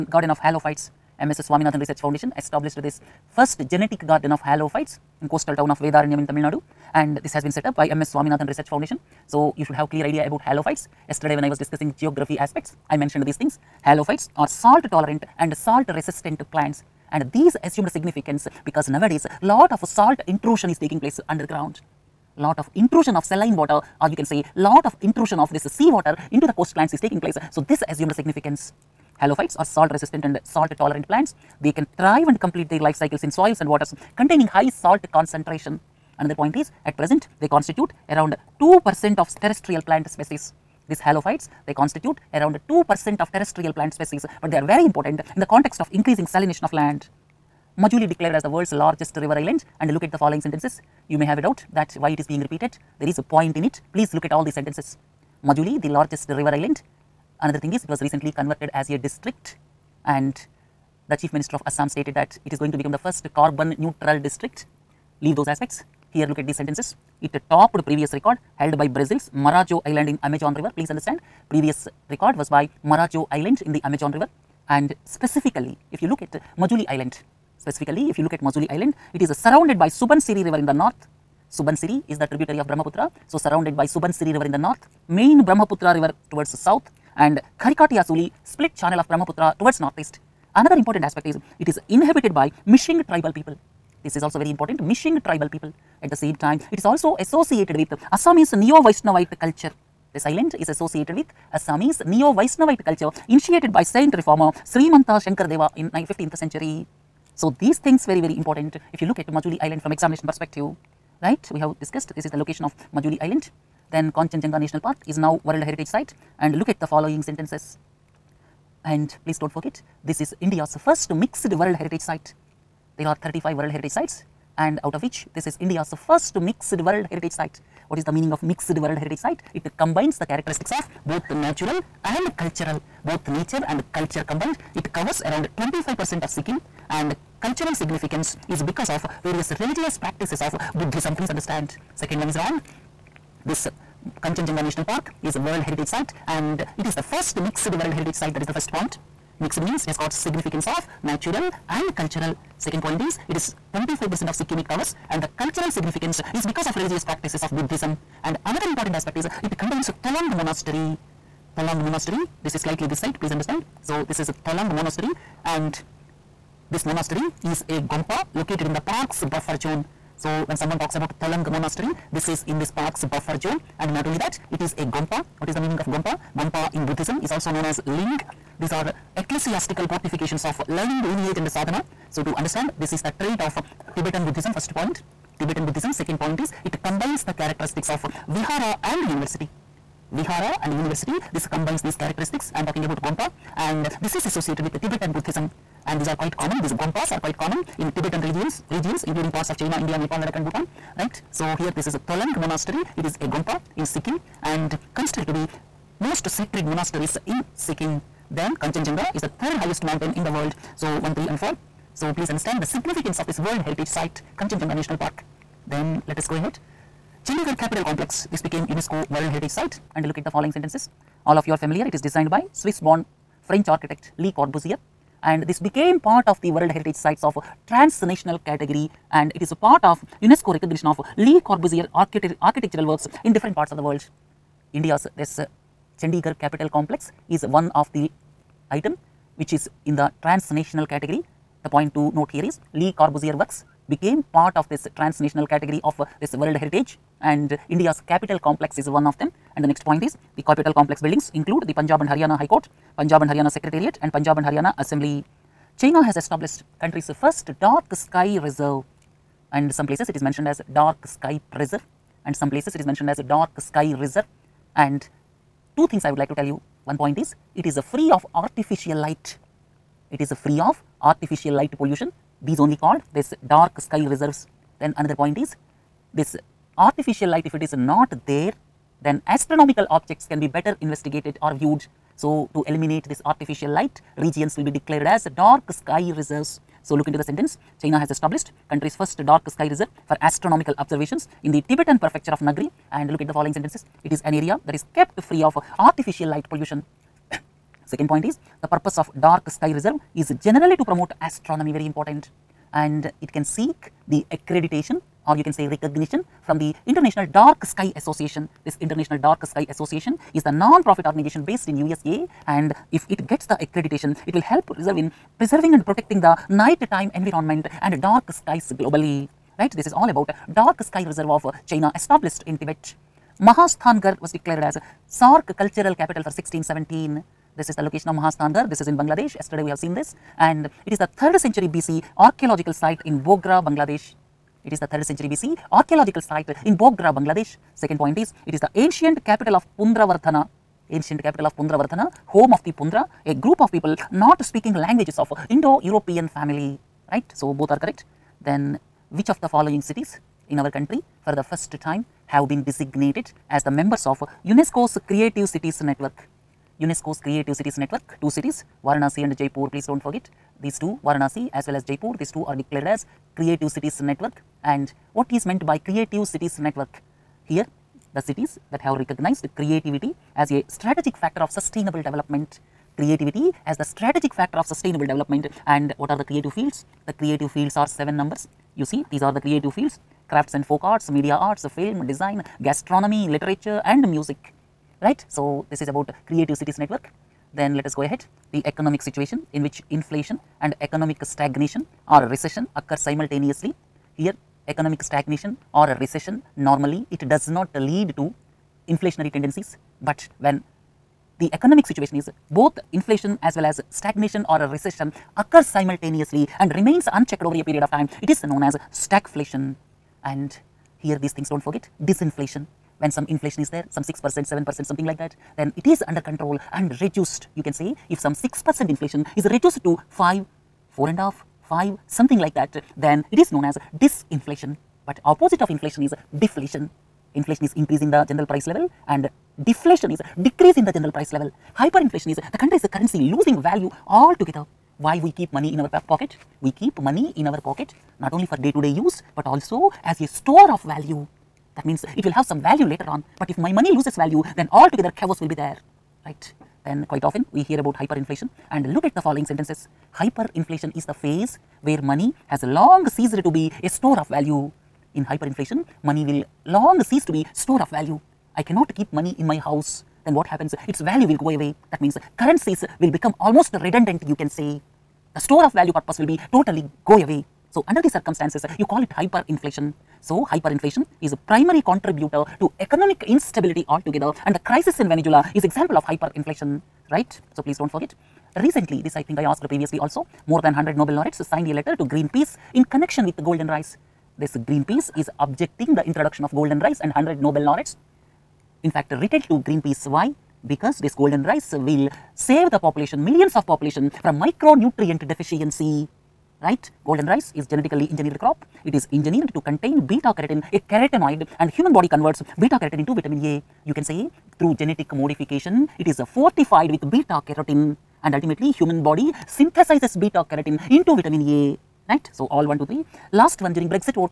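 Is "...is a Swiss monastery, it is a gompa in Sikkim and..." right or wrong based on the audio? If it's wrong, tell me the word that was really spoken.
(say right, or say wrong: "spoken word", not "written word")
wrong: "Tholung", not "Swiss".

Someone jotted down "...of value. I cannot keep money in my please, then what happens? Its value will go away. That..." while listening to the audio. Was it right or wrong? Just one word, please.
wrong.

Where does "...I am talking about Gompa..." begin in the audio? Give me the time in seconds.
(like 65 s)
192 s.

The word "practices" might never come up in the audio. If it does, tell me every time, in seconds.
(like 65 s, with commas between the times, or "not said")
139 s, 157 s.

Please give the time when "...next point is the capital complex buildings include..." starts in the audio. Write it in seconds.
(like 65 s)
249 s.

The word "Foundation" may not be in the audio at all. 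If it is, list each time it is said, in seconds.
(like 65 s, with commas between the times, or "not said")
1 s, 8 s.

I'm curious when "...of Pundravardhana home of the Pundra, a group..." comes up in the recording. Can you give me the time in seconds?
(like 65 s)
341 s.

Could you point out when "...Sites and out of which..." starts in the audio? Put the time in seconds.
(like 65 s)
123 s.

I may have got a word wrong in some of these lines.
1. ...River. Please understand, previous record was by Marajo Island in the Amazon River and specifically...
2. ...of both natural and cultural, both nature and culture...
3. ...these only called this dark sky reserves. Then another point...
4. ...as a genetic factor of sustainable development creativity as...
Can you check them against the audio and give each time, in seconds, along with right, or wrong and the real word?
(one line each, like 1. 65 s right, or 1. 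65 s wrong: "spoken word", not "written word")
1. 70 s right
2. 130 s right
3. 272 s right
4. 370 s wrong: "strategic", not "genetic".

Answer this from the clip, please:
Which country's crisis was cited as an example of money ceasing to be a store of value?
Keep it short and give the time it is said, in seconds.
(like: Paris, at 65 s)
Venezuela, at 475 s.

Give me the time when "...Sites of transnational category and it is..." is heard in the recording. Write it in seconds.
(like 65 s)
226 s.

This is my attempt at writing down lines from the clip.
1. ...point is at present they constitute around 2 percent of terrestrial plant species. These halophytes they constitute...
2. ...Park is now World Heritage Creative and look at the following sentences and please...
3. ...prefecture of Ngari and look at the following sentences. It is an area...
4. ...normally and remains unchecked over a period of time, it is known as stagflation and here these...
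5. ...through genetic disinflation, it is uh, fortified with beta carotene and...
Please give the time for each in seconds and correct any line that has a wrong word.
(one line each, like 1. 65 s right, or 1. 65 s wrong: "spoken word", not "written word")
1. 36 s right
2. 114 s wrong: "Site", not "Creative"
3. 291 s right
4. 405 s wrong: "simultaneously", not "normally"
5. 504 s wrong: "modification", not "disinflation".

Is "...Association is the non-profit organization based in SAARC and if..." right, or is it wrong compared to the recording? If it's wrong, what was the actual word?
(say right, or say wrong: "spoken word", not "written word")
wrong: "USA", not "SAARC".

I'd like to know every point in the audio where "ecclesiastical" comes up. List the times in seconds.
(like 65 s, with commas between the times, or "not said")
179 s.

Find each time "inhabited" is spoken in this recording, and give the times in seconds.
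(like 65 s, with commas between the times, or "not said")
91 s.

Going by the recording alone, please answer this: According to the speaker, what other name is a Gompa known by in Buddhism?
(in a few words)
Ling.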